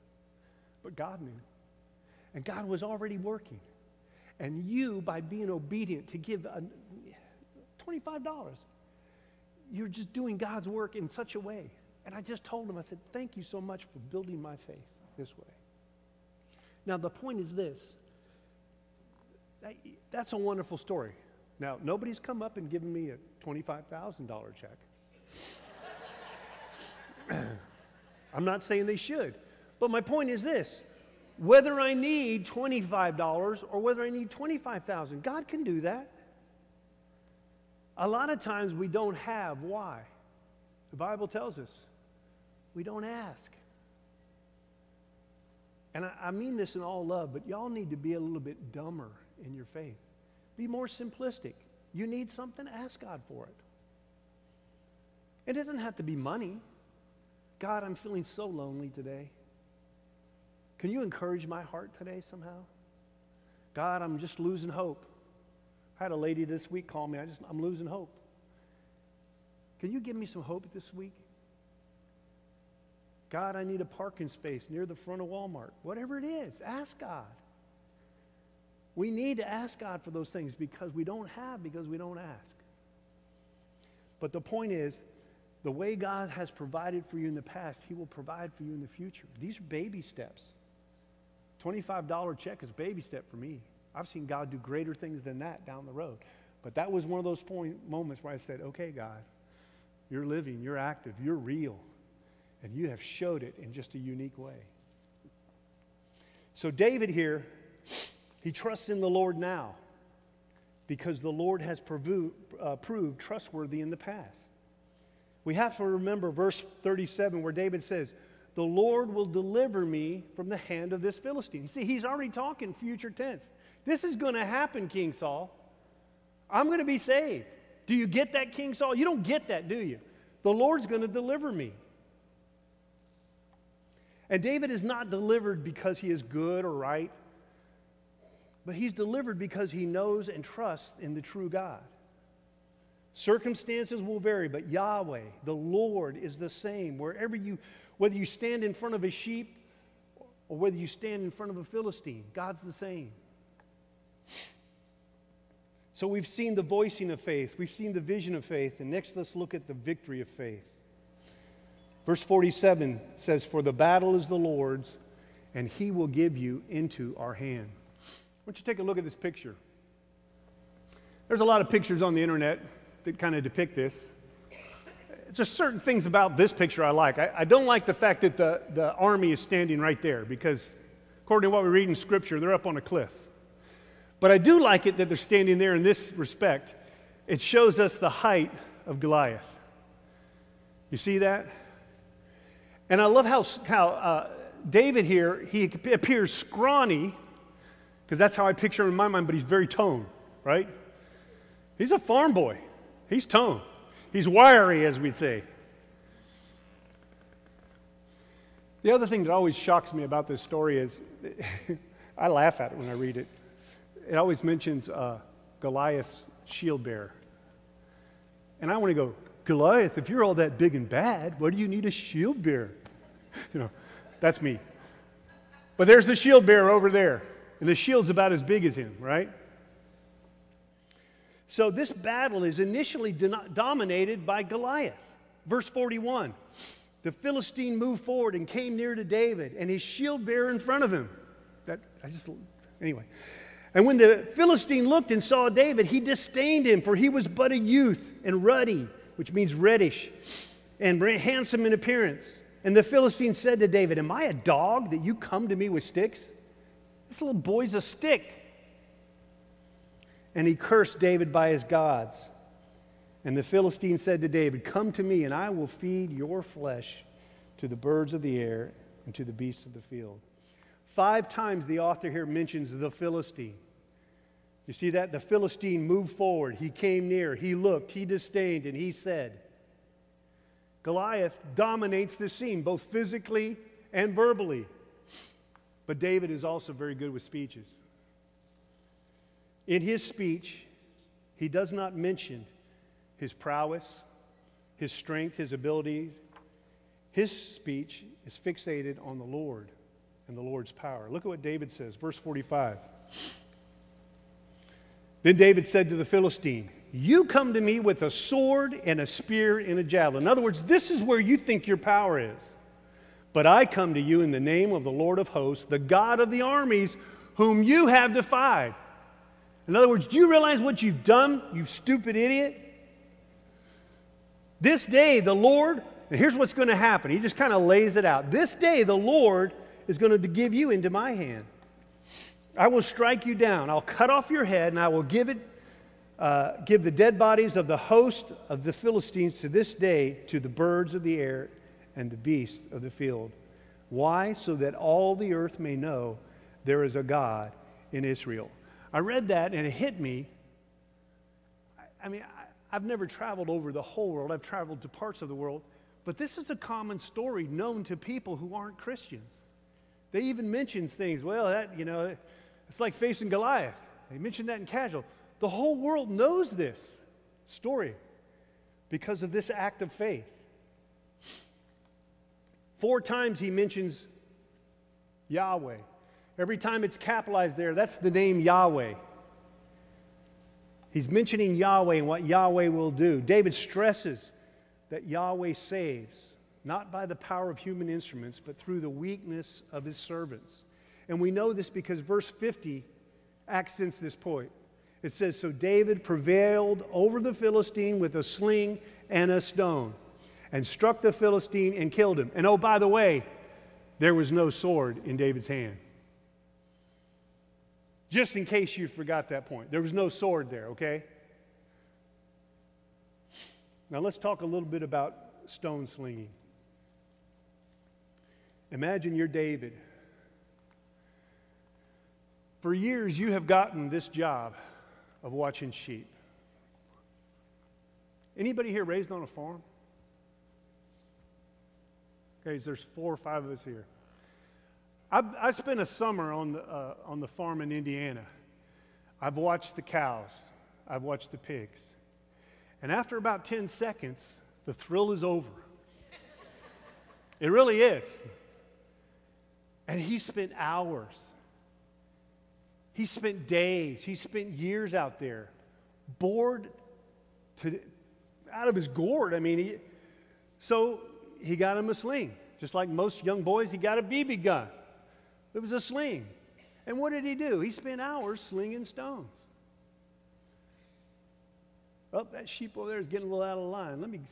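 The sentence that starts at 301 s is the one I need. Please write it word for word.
Look at what David says, verse 45.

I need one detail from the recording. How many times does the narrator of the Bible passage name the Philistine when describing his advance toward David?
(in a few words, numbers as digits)
5.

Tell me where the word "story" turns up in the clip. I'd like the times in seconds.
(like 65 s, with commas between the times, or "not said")
20 s, 210 s, 356 s, 367 s.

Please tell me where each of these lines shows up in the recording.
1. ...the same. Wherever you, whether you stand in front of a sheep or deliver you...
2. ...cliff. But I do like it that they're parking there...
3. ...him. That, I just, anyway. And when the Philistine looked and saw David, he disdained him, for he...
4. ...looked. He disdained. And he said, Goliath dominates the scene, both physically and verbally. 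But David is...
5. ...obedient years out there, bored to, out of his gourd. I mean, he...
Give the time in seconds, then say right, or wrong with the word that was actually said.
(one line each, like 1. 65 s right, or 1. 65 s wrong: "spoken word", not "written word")
1. 146 s wrong: "whether", not "deliver"
2. 182 s wrong: "standing", not "parking"
3. 240 s right
4. 277 s right
5. 454 s wrong: "spent", not "obedient".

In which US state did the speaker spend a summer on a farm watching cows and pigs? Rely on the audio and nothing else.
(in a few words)
Indiana.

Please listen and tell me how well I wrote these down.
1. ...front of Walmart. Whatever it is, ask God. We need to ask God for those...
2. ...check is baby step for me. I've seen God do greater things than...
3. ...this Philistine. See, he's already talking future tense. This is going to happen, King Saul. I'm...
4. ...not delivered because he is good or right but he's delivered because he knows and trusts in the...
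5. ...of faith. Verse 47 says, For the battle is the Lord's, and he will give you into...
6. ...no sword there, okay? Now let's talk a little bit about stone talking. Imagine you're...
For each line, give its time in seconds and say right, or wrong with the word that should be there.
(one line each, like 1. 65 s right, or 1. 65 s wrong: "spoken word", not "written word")
1. 74 s right
2. 92 s right
3. 121 s right
4. 134 s right
5. 160 s right
6. 409 s wrong: "slinging", not "talking".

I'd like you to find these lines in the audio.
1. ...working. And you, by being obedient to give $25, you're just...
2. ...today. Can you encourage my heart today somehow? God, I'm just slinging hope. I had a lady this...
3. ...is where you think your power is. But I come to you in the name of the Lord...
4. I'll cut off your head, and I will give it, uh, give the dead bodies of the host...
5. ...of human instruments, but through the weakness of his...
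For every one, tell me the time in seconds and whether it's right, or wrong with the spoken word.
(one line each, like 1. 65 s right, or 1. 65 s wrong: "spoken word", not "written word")
1. 3 s right
2. 58 s wrong: "losing", not "slinging"
3. 310 s right
4. 333 s right
5. 387 s right.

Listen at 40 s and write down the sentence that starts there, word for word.
The Bible tells us we don't ask.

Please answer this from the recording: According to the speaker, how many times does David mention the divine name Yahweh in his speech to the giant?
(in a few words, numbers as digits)
4.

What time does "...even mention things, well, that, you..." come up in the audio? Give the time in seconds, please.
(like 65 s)
360 s.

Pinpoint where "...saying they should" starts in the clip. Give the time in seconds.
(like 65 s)
28 s.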